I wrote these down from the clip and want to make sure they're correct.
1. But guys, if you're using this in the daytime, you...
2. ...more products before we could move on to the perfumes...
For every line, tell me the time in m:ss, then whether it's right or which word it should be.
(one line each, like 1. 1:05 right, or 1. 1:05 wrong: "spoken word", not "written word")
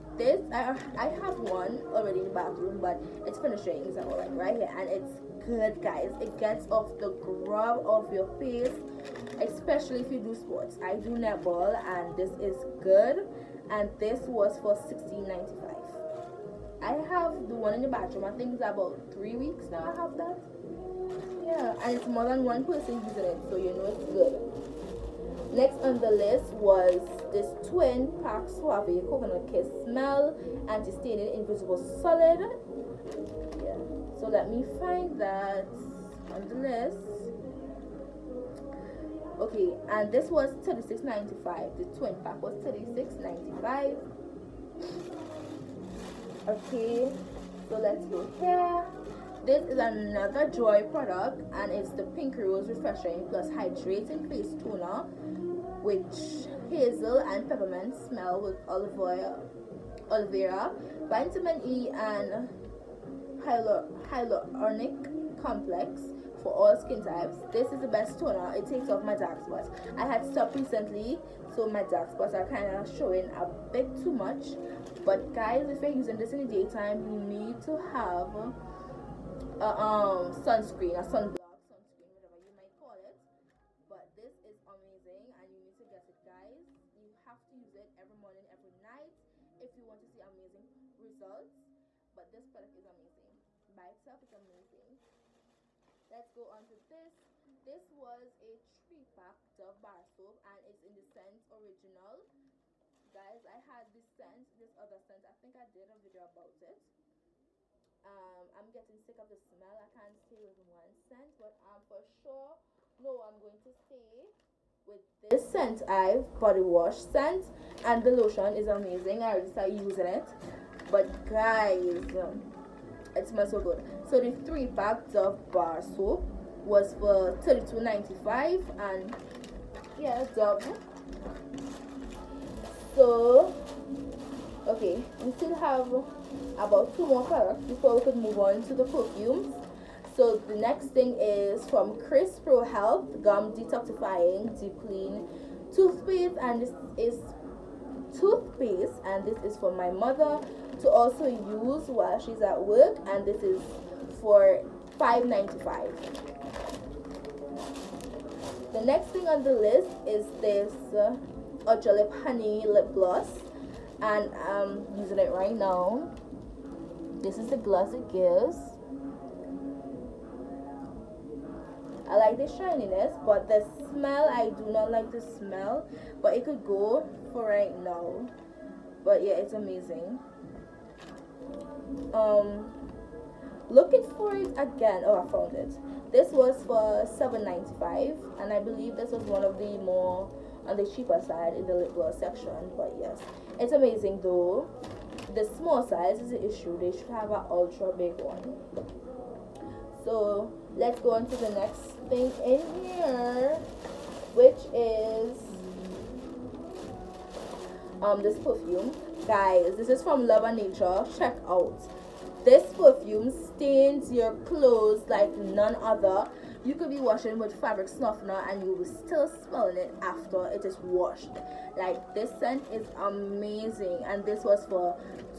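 1. 1:15 right
2. 2:17 right.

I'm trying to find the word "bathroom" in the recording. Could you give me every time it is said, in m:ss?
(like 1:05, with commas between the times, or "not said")
0:02, 0:17.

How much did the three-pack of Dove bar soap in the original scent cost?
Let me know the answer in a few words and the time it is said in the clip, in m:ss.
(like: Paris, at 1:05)
32.95, at 2:07.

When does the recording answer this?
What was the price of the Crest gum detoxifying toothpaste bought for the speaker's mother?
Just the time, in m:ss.
2:34.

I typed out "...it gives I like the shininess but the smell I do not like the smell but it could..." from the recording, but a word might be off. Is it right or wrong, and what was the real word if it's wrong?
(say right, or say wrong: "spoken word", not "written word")
right.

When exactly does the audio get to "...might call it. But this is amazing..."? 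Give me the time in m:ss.
1:22.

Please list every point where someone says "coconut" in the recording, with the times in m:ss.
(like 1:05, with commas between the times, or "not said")
0:29.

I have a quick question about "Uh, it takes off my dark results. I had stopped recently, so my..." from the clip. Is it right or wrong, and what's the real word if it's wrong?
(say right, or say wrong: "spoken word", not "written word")
wrong: "spots", not "results".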